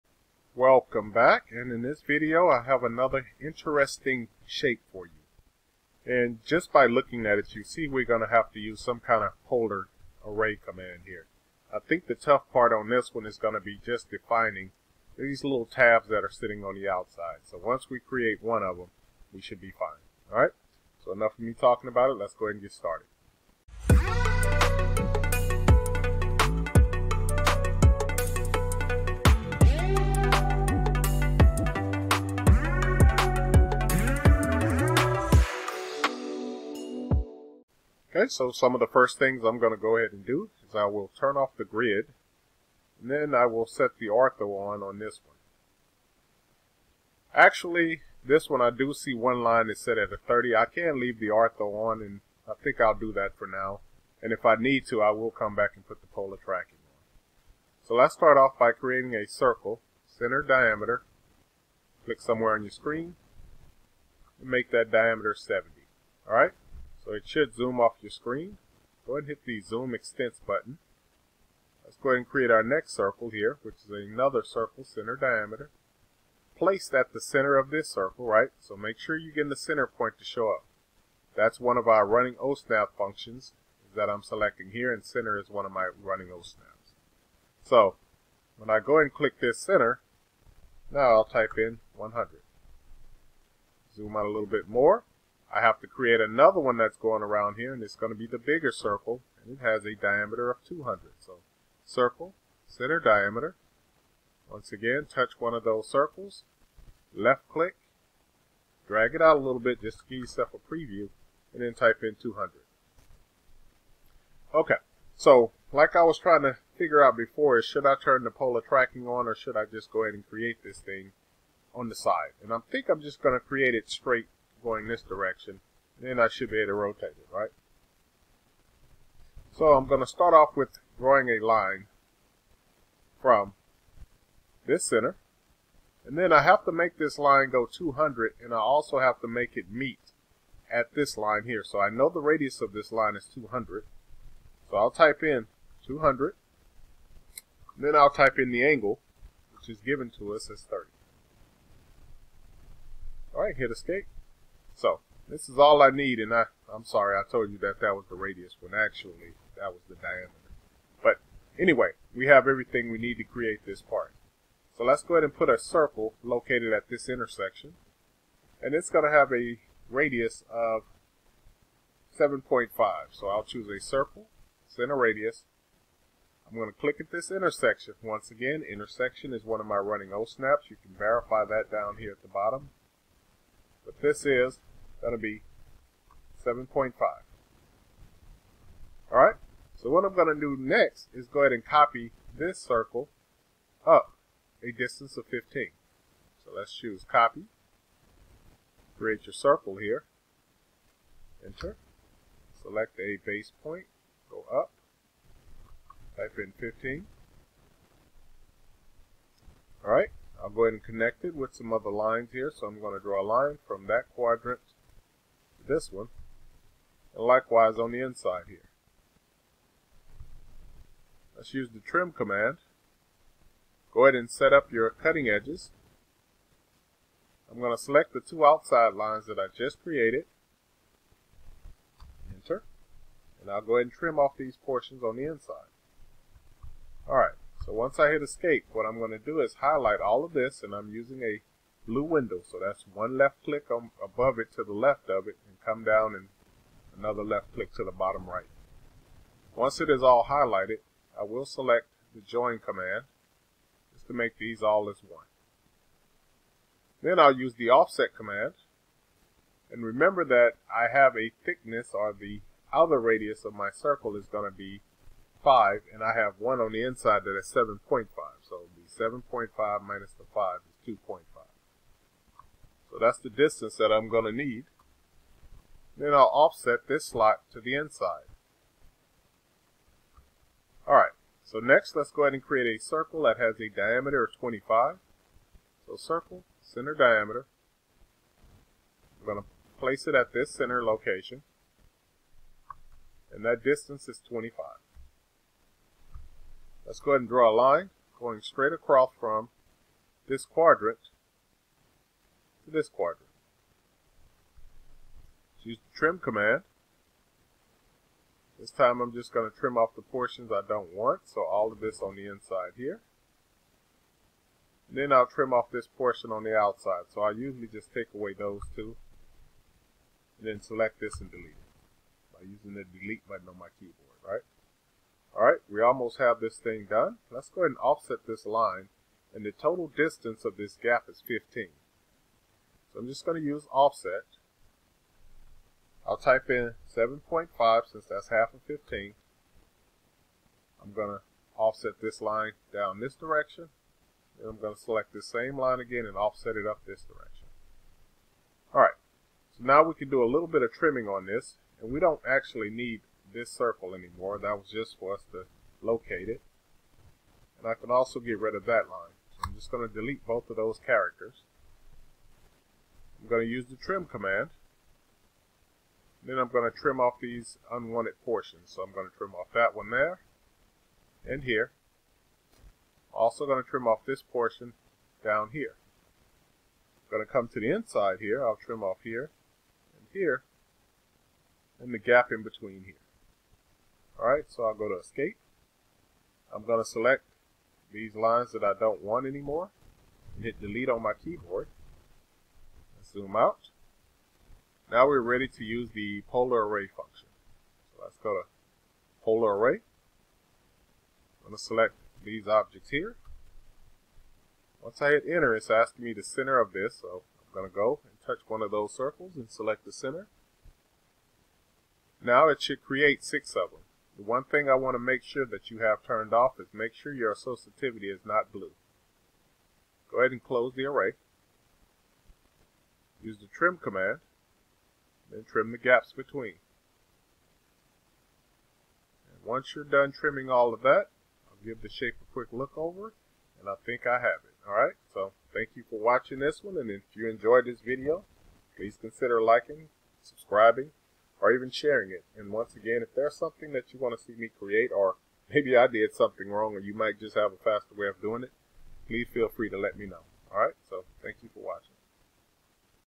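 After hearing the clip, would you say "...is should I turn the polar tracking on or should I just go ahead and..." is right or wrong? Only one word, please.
right.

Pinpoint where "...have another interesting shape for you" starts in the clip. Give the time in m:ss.
0:02.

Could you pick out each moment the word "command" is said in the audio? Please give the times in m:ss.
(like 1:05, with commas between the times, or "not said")
0:10, 3:42, 4:12, 4:18, 5:06, 6:04, 7:03.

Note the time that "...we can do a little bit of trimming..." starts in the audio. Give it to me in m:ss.
5:49.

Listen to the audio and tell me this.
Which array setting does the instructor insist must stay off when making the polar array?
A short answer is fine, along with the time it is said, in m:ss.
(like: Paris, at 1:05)
associativity, at 6:57.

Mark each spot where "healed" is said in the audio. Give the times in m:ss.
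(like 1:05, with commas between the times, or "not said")
not said.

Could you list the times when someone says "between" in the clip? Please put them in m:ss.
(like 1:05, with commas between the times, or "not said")
6:22, 7:06.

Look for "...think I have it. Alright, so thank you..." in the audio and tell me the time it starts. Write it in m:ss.
7:13.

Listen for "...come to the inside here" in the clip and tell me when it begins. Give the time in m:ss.
6:17.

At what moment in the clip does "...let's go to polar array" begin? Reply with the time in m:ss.
6:38.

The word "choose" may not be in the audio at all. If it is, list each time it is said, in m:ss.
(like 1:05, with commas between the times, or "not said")
2:53, 3:16.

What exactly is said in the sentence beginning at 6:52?
Now it should create six of them.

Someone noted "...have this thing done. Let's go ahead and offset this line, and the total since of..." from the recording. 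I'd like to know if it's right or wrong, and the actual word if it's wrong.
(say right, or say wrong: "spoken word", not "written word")
wrong: "distance", not "since".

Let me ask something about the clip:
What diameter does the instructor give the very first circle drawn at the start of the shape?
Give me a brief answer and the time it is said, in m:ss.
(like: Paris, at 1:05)
70, at 1:05.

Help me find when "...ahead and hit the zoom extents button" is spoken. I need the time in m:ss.
1:09.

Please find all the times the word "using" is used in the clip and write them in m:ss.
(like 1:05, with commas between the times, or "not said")
4:00, 5:22.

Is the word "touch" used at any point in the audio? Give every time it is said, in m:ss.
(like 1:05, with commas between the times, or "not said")
1:45, 6:48.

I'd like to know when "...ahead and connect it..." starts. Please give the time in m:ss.
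3:30.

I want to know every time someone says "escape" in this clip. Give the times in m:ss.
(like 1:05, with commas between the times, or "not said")
2:33, 3:58, 6:24.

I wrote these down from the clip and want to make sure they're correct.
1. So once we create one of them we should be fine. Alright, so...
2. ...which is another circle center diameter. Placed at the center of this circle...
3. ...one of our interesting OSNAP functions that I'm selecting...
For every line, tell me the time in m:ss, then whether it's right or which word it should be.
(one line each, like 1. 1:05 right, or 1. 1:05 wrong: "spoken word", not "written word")
1. 0:17 right
2. 1:13 right
3. 1:21 wrong: "running", not "interesting".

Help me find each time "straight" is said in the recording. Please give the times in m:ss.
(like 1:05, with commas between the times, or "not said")
2:03, 4:58.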